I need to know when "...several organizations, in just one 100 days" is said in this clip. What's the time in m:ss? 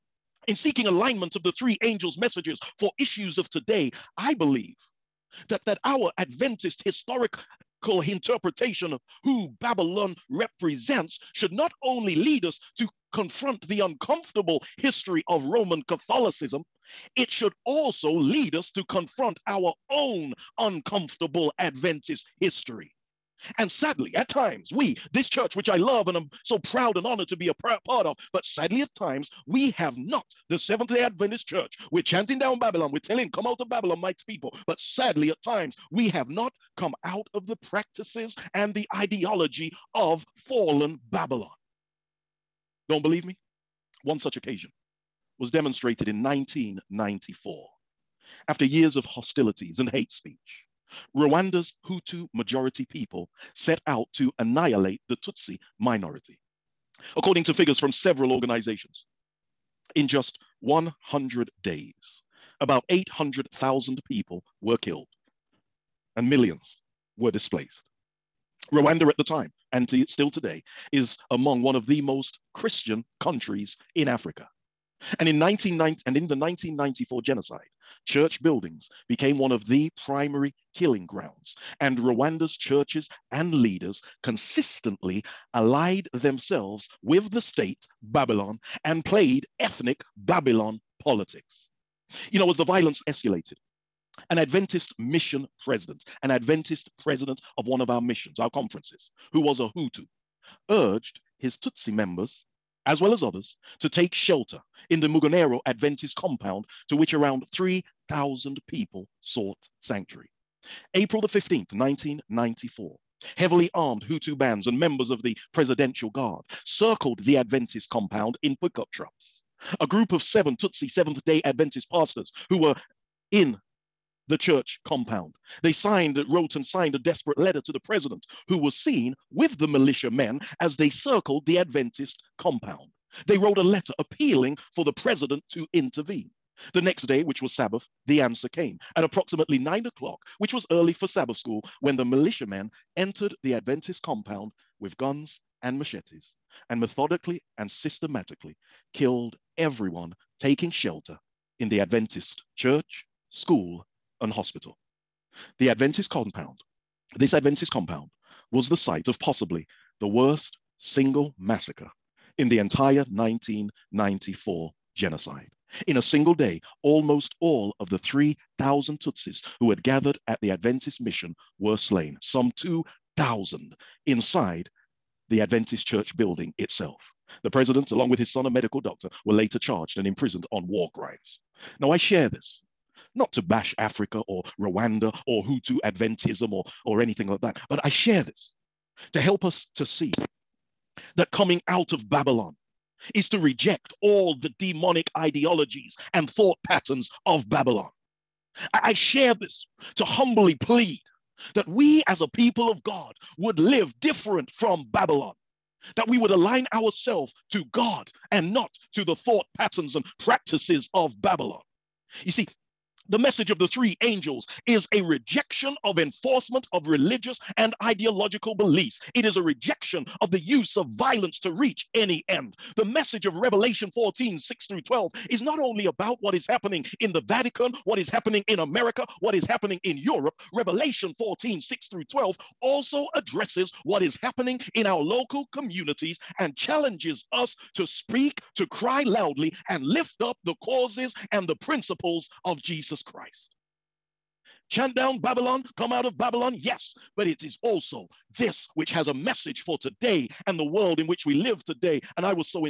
0:57.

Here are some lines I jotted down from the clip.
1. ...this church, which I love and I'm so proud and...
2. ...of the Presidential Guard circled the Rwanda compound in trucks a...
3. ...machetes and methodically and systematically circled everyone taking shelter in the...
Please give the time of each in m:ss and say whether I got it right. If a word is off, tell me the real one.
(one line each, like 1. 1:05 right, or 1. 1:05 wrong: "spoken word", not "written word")
1. 0:25 right
2. 1:55 wrong: "Adventist", not "Rwanda"
3. 2:25 wrong: "killed", not "circled".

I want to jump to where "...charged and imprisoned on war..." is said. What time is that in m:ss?
2:59.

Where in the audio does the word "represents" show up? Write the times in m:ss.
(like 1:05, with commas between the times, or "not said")
0:10.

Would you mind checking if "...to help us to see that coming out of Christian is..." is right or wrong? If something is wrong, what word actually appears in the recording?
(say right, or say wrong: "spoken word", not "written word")
wrong: "Babylon", not "Christian".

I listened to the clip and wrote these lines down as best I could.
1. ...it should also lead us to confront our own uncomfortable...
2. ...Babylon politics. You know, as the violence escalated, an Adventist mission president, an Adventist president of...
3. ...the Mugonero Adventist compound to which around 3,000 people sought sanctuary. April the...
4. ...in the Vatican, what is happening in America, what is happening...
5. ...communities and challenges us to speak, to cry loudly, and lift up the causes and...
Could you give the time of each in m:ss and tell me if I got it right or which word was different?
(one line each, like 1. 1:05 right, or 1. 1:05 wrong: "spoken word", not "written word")
1. 0:17 right
2. 1:30 right
3. 1:44 right
4. 3:46 right
5. 3:55 right.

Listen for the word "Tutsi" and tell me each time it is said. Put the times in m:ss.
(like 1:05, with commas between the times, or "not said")
0:55, 1:41, 2:00, 2:48.